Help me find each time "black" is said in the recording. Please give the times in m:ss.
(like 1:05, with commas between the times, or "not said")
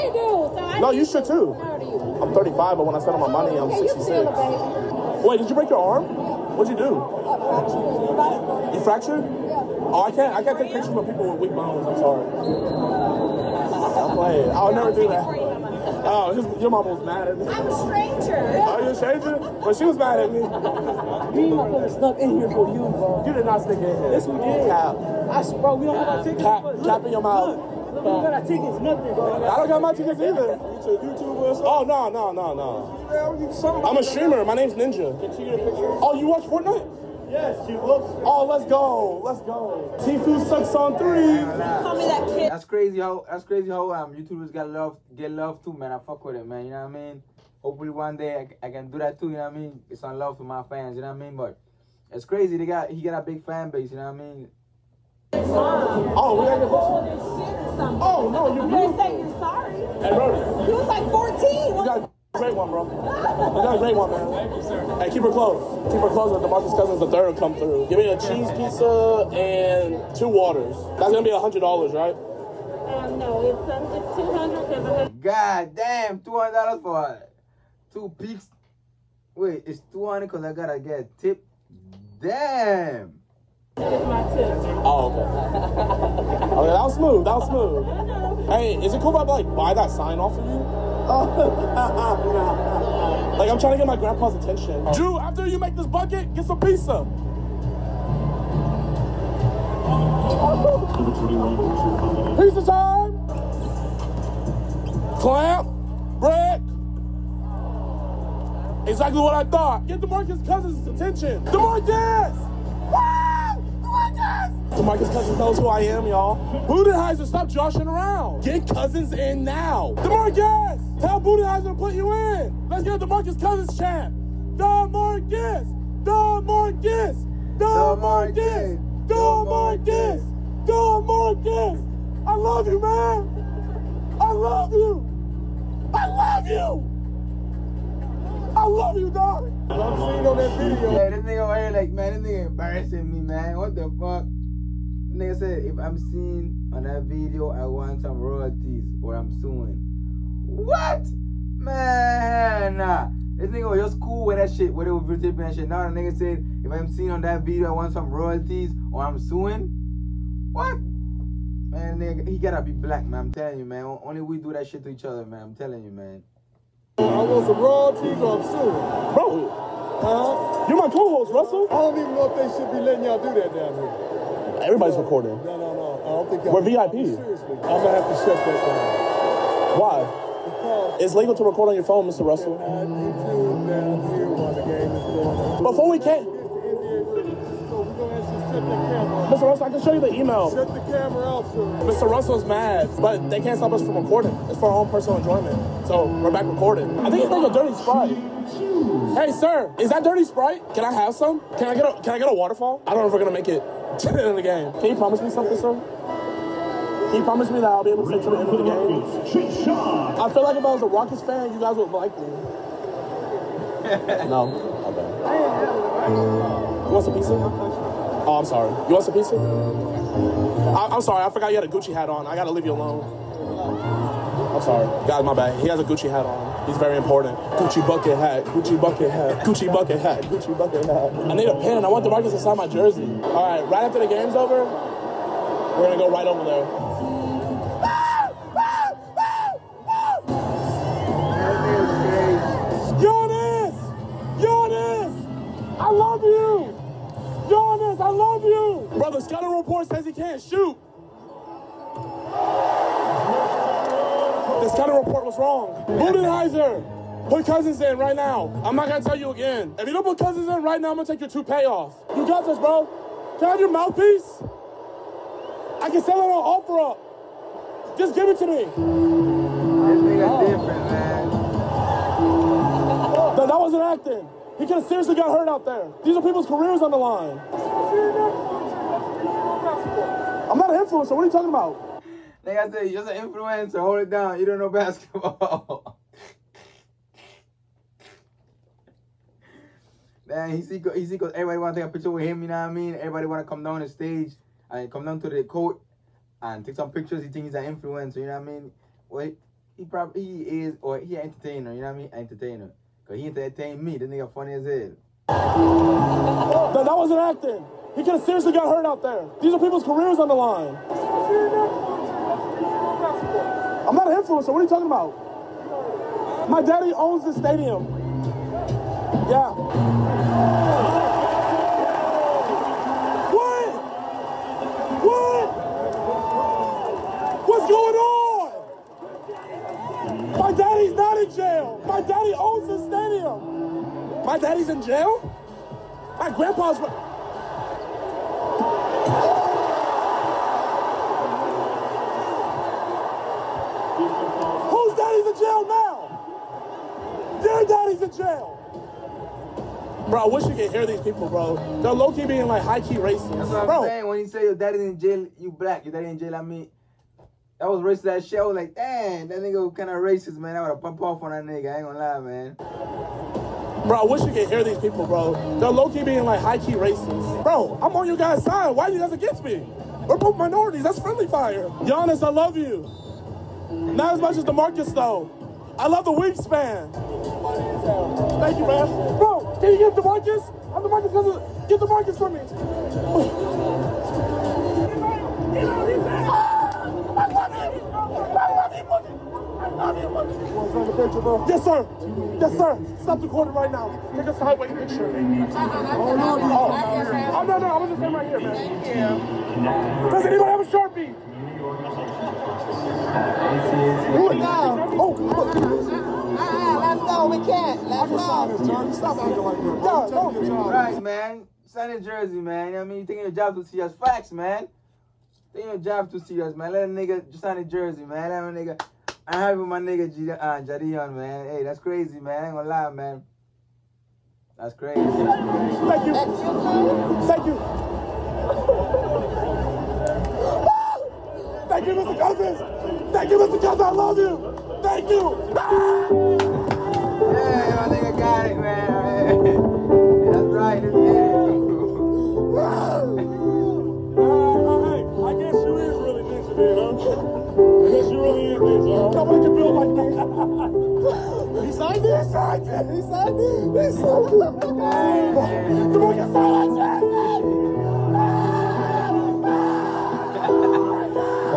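2:42, 5:55.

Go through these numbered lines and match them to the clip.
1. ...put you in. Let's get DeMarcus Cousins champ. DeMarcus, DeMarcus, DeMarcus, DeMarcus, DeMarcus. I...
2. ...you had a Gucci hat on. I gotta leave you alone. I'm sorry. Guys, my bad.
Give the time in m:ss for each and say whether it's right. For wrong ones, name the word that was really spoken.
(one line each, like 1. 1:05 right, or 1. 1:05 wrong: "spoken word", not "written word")
1. 2:01 right
2. 3:41 right.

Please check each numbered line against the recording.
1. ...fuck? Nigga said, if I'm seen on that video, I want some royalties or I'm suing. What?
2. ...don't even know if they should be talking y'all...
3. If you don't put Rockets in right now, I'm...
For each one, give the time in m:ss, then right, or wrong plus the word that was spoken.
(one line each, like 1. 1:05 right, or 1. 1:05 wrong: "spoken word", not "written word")
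1. 2:23 right
2. 2:51 wrong: "letting", not "talking"
3. 4:19 wrong: "Cousins", not "Rockets".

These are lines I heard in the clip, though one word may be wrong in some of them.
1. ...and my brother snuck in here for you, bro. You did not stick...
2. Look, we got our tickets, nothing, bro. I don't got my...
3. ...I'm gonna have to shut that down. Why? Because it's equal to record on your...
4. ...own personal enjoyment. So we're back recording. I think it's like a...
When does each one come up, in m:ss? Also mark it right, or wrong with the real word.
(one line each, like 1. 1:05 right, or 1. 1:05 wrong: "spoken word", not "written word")
1. 0:21 right
2. 0:27 right
3. 2:57 wrong: "legal", not "equal"
4. 3:14 right.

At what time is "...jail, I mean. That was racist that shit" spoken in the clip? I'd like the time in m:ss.
5:56.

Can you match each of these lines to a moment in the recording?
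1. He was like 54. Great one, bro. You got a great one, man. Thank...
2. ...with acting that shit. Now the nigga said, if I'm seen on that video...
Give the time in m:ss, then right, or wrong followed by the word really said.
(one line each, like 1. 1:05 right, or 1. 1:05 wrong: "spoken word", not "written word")
1. 1:00 wrong: "14", not "54"
2. 2:34 wrong: "videotaping", not "acting".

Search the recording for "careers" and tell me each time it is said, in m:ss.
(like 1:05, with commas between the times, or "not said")
4:36, 5:09.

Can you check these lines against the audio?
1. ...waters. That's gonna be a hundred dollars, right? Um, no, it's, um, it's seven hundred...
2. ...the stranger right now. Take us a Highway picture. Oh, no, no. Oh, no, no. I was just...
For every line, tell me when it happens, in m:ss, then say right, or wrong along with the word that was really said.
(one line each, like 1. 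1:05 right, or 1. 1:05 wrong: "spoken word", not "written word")
1. 1:10 wrong: "two", not "seven"
2. 6:33 wrong: "corner", not "stranger".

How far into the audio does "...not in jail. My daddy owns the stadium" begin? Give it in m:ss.
5:30.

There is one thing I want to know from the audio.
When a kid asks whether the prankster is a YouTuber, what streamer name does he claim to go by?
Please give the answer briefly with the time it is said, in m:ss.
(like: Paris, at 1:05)
Ninja, at 0:34.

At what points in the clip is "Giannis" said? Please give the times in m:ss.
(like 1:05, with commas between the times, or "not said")
6:11.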